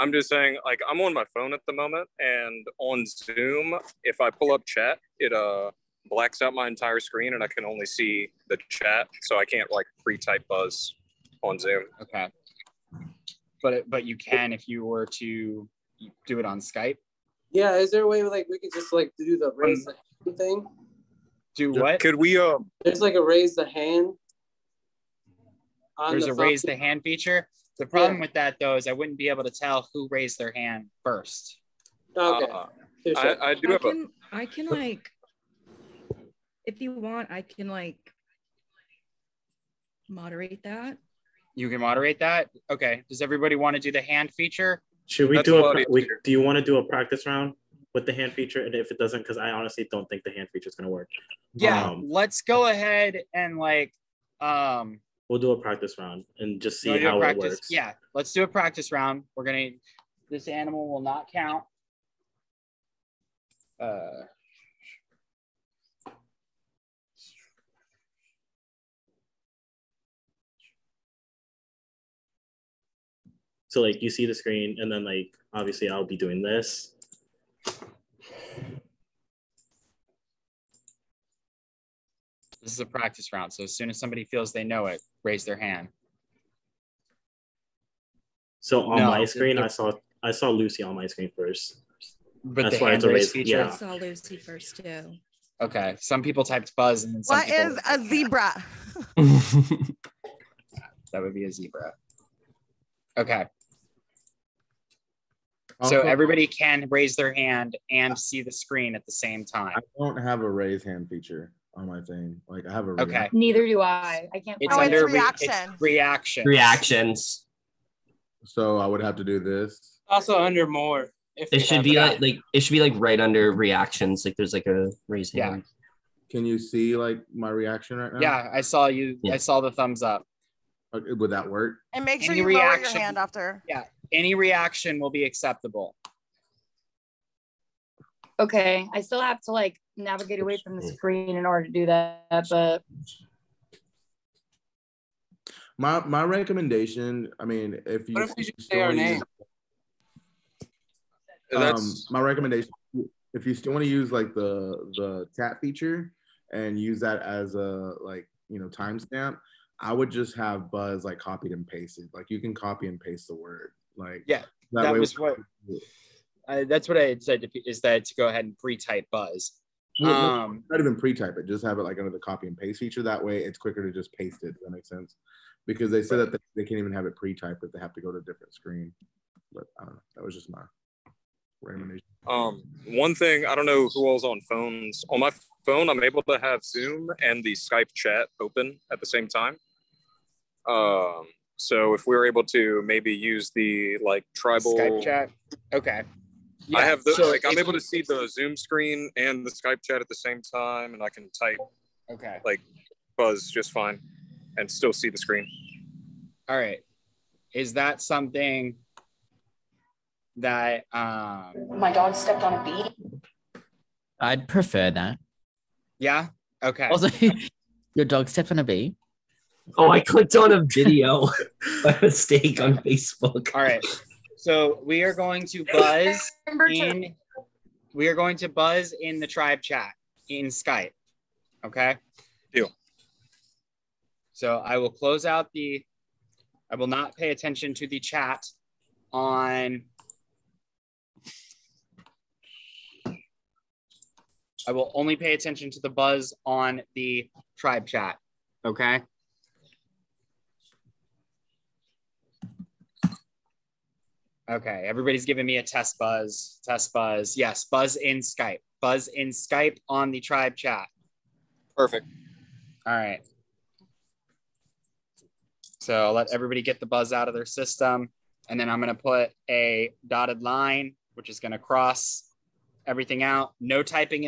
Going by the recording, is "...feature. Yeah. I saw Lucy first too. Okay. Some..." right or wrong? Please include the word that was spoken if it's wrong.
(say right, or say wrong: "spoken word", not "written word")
right.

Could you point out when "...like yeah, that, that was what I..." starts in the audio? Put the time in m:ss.
2:43.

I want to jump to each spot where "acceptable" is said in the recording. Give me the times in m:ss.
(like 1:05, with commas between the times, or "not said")
2:15.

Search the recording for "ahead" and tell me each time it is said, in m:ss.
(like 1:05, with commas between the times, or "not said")
0:52, 2:48.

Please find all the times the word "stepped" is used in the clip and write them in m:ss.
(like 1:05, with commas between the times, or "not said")
3:32, 3:38.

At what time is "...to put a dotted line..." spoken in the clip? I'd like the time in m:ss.
4:28.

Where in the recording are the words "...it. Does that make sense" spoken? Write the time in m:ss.
2:54.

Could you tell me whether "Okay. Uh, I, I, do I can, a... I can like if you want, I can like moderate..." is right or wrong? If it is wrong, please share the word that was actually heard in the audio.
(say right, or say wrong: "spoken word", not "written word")
right.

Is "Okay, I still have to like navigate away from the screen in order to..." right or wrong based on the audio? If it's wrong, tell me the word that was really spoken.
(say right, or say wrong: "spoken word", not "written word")
right.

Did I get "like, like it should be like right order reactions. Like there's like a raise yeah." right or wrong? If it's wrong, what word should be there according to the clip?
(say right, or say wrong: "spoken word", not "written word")
wrong: "under", not "order".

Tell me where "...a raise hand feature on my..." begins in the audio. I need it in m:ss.
1:50.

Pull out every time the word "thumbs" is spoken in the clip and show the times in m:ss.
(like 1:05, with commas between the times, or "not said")
2:09.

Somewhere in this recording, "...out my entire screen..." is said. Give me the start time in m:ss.
0:06.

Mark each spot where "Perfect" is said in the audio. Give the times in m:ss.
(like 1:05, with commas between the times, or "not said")
4:21.